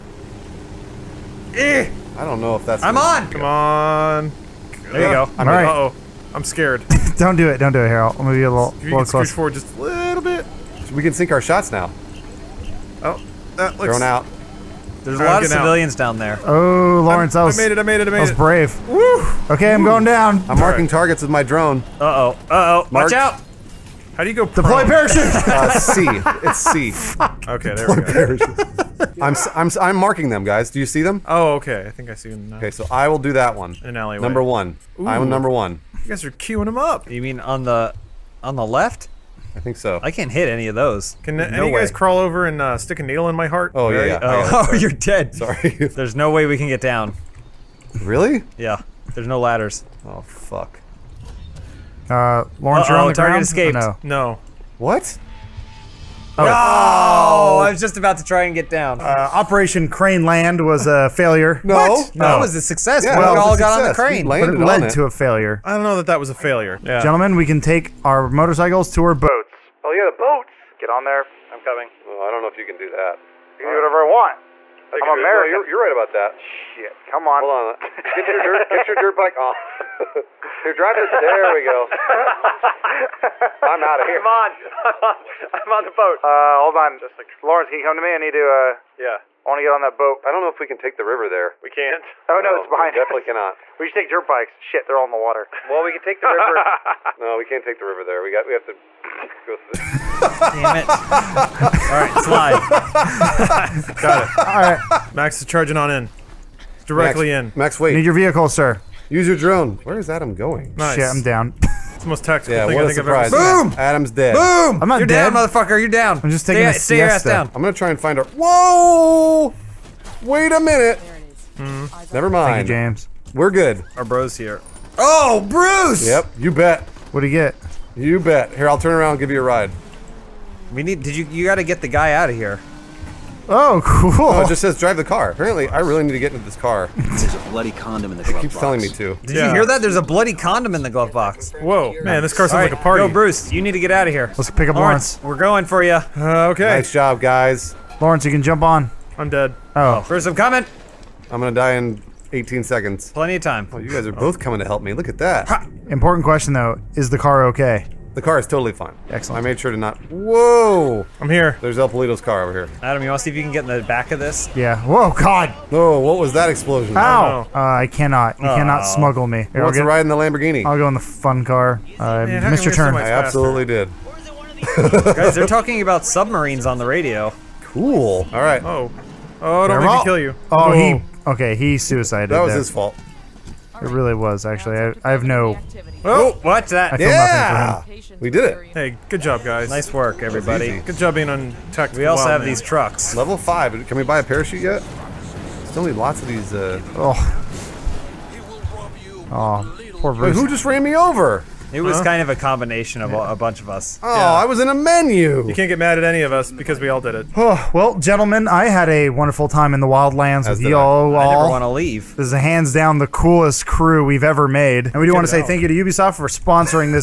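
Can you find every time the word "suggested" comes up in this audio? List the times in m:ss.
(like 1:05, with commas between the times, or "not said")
not said.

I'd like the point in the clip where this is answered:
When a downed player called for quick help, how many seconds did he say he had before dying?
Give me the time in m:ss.
2:32.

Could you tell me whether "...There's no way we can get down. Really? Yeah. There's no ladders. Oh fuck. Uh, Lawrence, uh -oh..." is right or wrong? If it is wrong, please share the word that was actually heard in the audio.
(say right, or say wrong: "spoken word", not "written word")
right.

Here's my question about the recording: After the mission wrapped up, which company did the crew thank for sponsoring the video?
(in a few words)
Ubisoft.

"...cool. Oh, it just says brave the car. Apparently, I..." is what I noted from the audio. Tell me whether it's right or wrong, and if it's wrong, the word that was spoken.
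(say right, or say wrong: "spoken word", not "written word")
wrong: "drive", not "brave".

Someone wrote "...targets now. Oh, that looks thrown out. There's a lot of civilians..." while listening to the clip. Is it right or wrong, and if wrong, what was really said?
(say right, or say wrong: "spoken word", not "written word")
wrong: "shots", not "targets".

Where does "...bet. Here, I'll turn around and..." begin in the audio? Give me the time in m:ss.
2:08.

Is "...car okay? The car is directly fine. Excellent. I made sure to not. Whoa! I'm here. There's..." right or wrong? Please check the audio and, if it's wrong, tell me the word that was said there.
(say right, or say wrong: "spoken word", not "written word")
wrong: "totally", not "directly".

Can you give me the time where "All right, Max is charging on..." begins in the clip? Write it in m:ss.
1:44.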